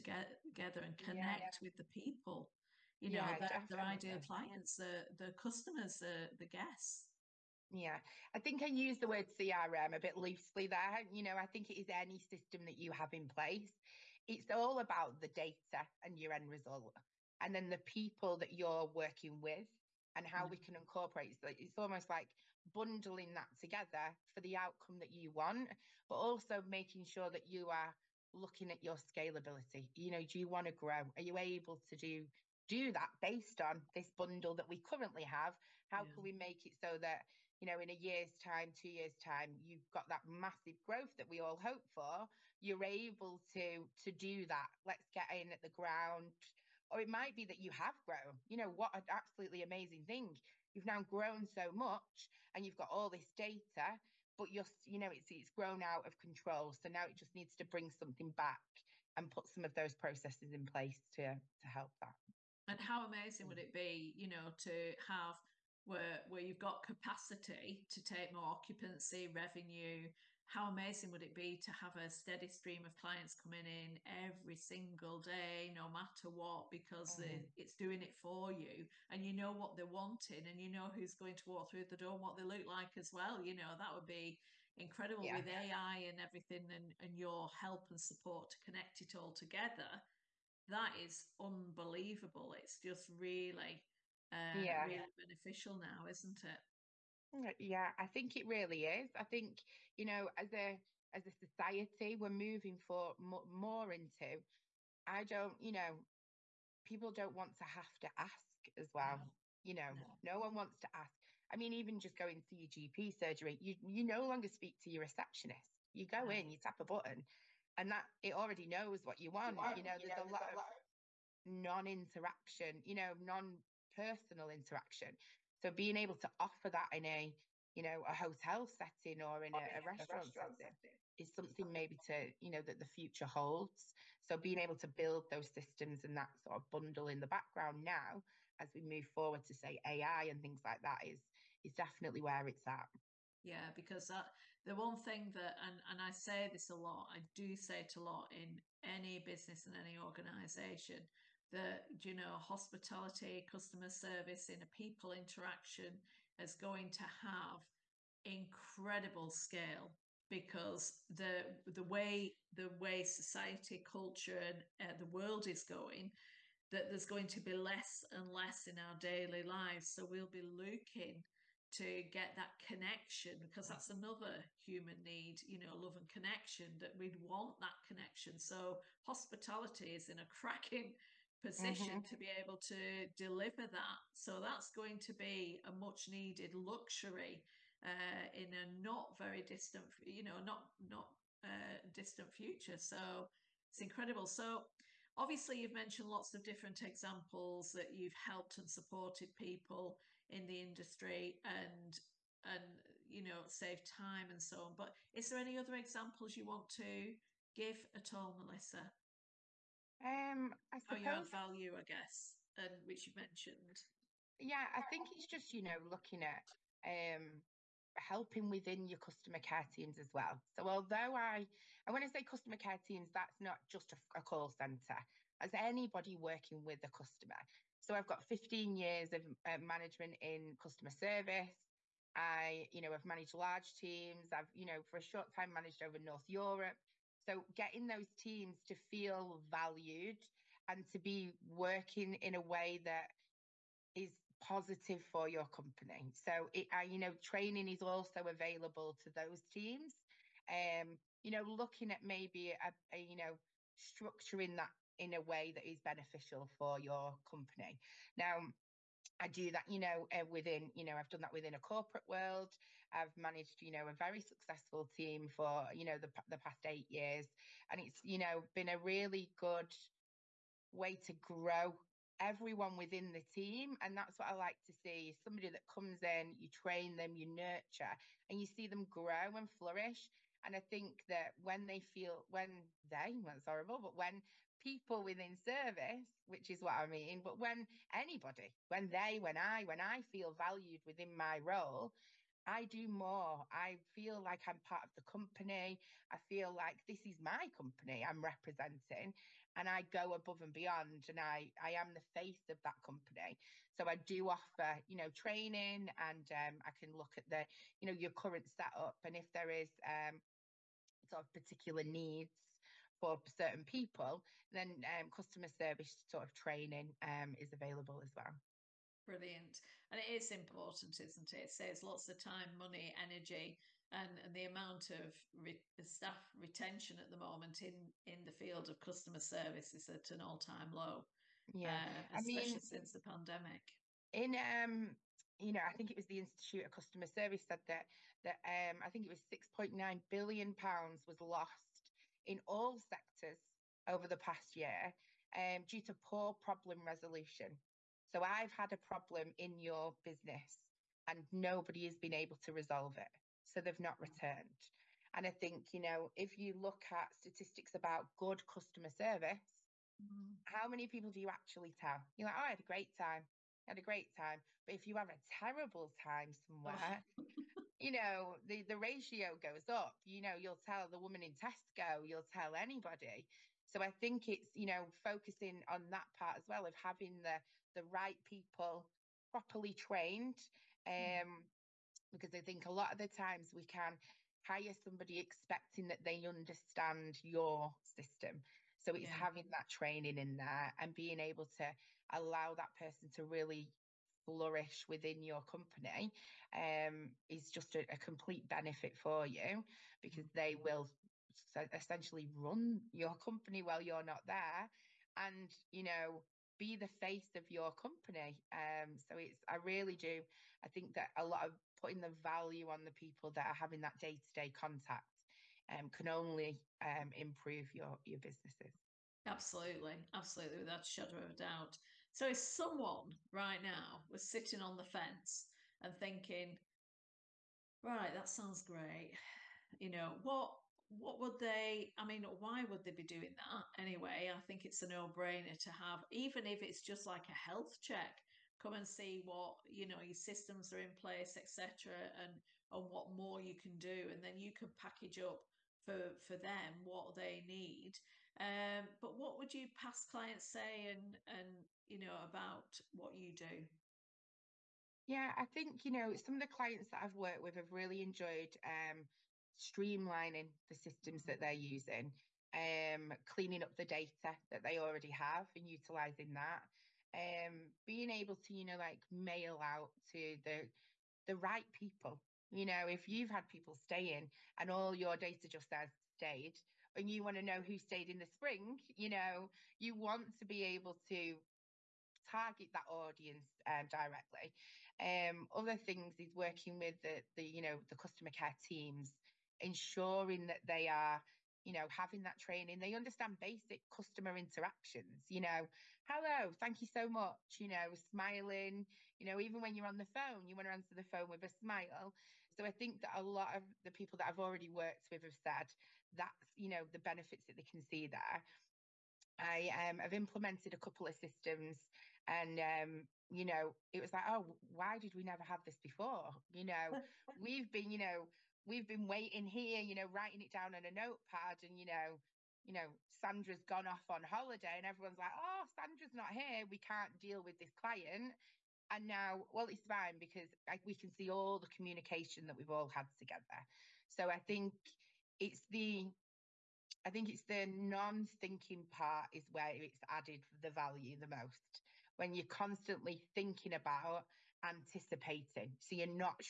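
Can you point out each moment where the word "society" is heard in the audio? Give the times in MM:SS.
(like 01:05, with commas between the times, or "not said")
01:41, 02:43.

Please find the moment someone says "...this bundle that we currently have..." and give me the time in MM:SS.
00:33.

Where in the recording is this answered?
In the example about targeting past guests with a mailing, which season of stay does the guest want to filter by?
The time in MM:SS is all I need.
07:58.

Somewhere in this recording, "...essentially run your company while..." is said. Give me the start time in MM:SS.
06:41.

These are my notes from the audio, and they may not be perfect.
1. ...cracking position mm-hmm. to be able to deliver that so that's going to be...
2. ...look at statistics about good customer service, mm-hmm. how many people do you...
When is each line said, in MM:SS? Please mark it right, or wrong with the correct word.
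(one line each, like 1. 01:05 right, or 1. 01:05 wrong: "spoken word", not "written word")
1. 03:00 right
2. 05:56 right.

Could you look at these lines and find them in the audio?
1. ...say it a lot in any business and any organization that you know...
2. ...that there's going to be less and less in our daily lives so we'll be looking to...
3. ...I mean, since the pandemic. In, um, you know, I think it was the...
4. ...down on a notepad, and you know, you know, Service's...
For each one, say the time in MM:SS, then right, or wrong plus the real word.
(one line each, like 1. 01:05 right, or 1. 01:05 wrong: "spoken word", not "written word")
1. 02:27 right
2. 02:46 right
3. 05:32 right
4. 08:40 wrong: "Sandra", not "Service".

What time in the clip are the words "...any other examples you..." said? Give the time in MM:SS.
03:25.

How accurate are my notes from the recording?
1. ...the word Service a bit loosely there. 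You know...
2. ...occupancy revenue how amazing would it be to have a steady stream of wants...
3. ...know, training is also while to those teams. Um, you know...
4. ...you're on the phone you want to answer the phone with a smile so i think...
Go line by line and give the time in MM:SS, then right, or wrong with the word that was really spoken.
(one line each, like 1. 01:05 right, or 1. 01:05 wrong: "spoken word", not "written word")
1. 00:08 wrong: "CRM", not "Service"
2. 01:08 wrong: "clients", not "wants"
3. 04:06 wrong: "available", not "while"
4. 08:19 right.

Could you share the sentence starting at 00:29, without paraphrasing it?
You know, do you want to grow?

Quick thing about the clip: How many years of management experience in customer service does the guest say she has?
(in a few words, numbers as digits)
15.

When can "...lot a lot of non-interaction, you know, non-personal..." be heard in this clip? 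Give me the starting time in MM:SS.
02:00.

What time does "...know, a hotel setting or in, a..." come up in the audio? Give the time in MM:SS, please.
02:07.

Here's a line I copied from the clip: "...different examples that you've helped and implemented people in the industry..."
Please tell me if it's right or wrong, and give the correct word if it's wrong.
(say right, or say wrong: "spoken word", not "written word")
wrong: "supported", not "implemented".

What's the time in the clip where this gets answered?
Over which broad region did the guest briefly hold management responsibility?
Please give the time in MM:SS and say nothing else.
03:55.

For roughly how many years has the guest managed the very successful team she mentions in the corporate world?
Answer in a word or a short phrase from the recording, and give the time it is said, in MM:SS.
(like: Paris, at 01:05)
8, at 04:26.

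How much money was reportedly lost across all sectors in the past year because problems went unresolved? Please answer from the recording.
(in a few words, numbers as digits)
6.9 billion pounds.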